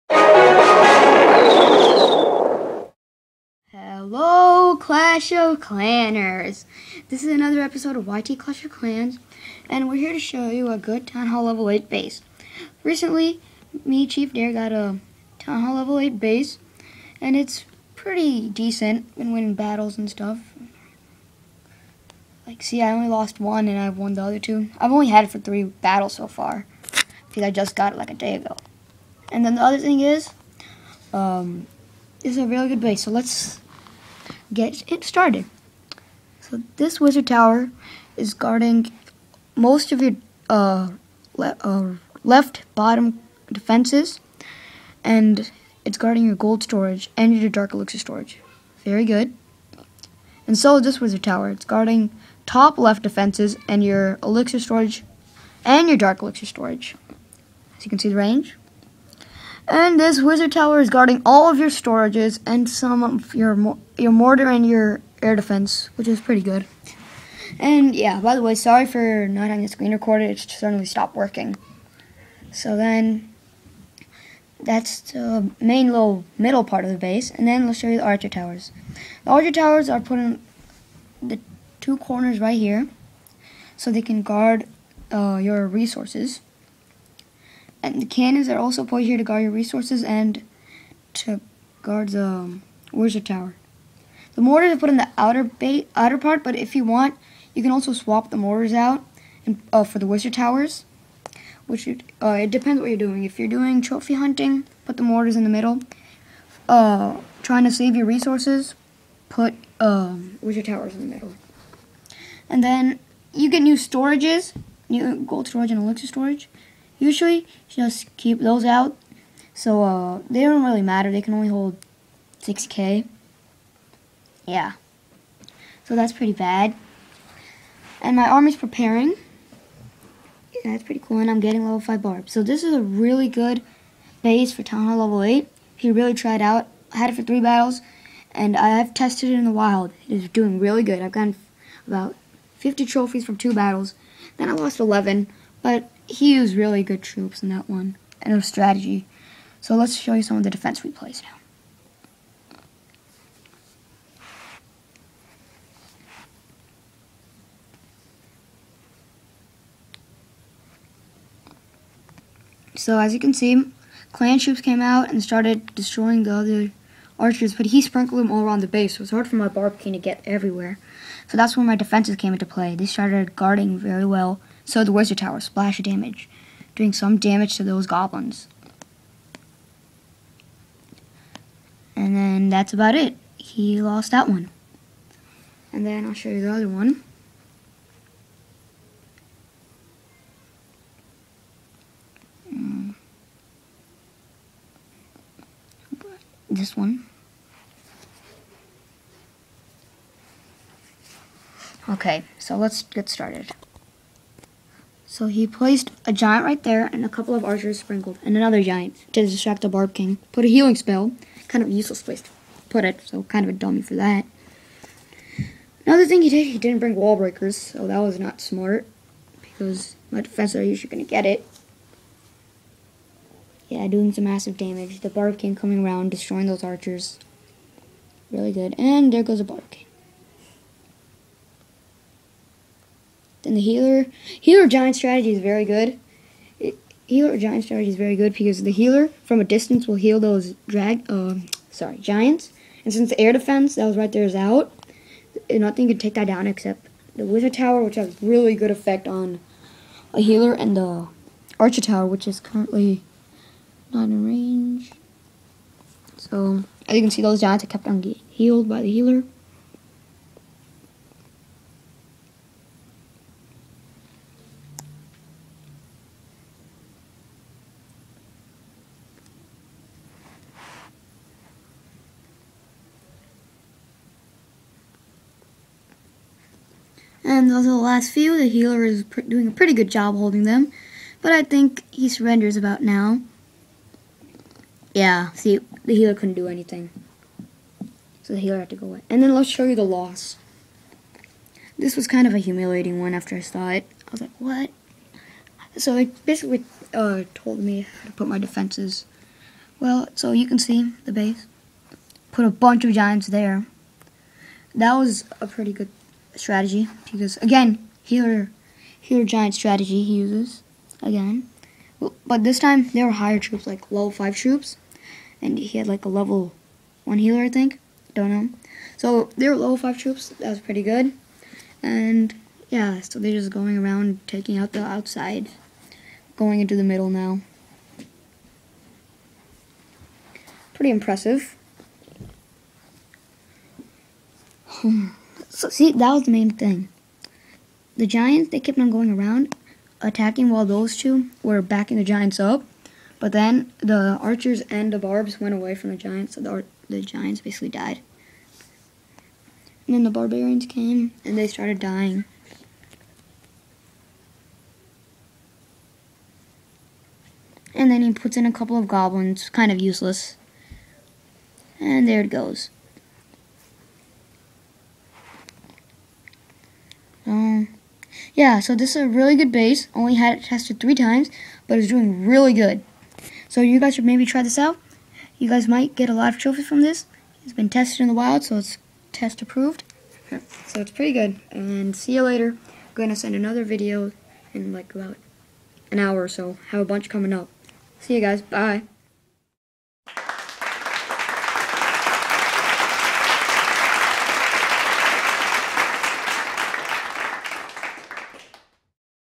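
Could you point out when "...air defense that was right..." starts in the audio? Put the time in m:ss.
4:03.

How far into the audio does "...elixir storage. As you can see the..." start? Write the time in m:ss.
0:56.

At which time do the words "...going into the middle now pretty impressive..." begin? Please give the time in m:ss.
5:26.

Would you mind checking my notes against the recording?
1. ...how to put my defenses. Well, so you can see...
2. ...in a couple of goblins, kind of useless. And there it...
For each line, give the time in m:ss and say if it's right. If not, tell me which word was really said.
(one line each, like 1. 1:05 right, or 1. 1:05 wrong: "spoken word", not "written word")
1. 4:58 right
2. 5:58 right.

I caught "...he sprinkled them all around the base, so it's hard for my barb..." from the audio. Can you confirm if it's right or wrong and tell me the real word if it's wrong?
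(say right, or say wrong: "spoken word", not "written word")
right.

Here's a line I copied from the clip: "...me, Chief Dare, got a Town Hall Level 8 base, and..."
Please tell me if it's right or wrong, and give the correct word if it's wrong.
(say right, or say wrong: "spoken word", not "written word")
right.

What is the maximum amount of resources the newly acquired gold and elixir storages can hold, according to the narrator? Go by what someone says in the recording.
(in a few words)
6K.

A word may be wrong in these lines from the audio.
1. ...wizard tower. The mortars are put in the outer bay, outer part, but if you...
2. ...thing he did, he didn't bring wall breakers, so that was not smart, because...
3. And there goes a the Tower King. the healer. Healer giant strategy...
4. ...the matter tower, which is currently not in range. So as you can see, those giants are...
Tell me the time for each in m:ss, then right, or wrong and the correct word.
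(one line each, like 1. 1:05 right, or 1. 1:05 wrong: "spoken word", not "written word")
1. 1:32 right
2. 3:36 right
3. 3:48 wrong: "Barb", not "Tower"
4. 4:10 wrong: "archer", not "matter".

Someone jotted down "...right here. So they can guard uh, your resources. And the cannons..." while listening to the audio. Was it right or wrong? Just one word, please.
right.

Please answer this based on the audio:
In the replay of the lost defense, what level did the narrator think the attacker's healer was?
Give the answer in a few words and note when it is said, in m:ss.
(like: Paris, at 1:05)
level 1, at 5:16.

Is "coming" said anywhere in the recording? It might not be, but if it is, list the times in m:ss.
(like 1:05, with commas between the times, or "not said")
3:45, 6:27.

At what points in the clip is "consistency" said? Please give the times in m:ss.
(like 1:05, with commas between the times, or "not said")
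not said.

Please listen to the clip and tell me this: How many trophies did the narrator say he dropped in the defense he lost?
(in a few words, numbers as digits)
11.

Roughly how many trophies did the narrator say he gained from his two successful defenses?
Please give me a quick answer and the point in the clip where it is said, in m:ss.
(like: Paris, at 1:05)
50, at 2:22.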